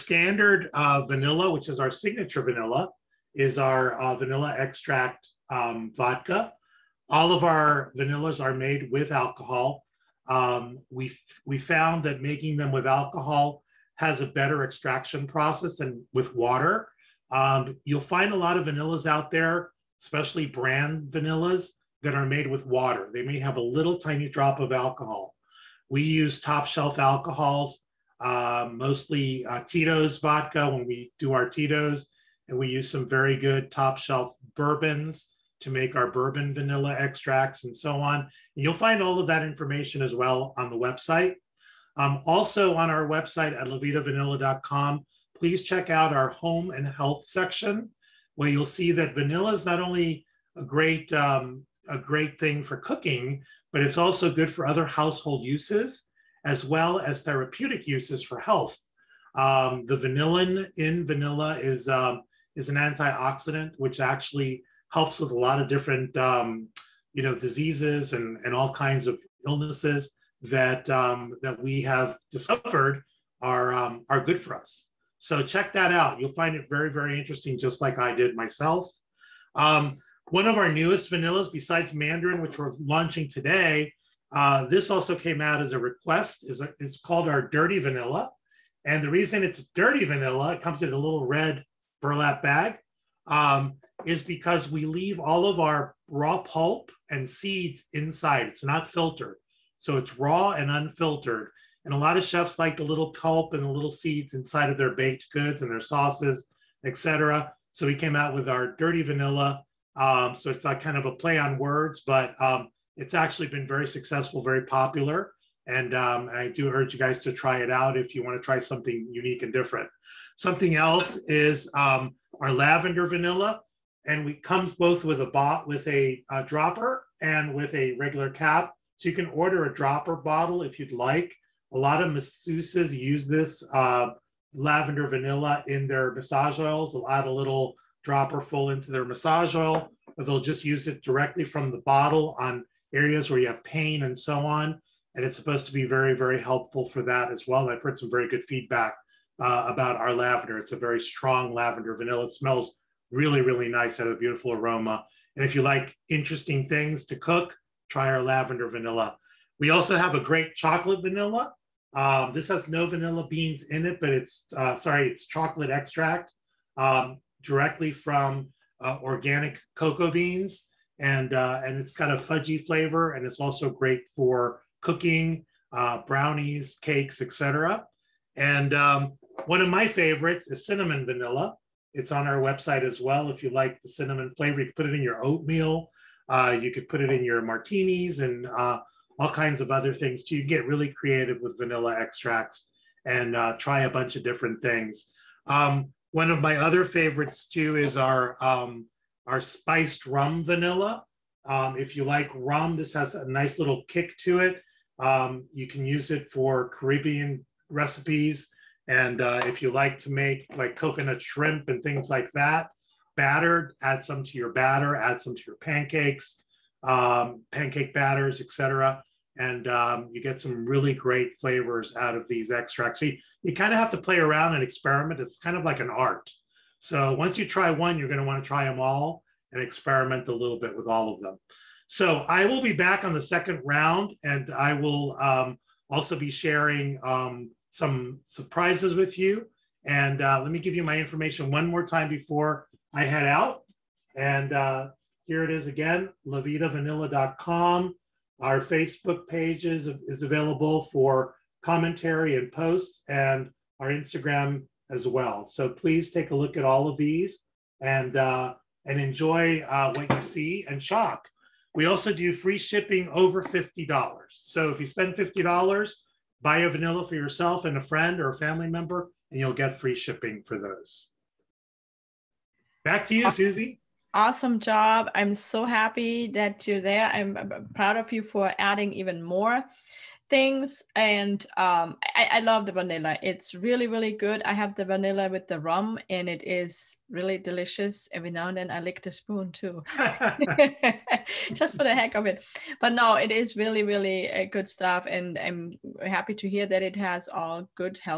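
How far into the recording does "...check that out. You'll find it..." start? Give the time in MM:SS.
01:15.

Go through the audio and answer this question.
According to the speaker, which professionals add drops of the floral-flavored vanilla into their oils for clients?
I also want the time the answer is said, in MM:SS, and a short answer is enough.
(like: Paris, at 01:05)
Masseuses, at 02:12.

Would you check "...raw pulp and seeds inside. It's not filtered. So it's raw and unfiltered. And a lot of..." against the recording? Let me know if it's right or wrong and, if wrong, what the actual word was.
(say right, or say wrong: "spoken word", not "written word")
right.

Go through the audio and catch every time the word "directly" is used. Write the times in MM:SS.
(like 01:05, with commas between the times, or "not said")
02:21, 02:47.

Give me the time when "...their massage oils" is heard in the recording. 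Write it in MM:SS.
02:15.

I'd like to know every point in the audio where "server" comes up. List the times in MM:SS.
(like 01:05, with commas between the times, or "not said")
not said.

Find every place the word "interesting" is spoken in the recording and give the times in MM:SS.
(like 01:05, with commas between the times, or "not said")
01:17, 02:36.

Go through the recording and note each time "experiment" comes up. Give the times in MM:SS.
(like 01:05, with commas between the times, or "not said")
03:44, 03:49.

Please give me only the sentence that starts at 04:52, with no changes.
But no, it is really, really uh, good stuff.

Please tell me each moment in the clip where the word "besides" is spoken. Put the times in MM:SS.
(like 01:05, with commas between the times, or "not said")
01:21.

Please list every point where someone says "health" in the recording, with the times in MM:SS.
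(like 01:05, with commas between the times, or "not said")
00:46, 00:58.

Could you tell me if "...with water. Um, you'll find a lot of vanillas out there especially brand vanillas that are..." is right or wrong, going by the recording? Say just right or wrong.
right.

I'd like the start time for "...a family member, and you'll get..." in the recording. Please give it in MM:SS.
04:28.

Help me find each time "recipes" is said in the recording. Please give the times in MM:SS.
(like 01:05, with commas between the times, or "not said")
03:27.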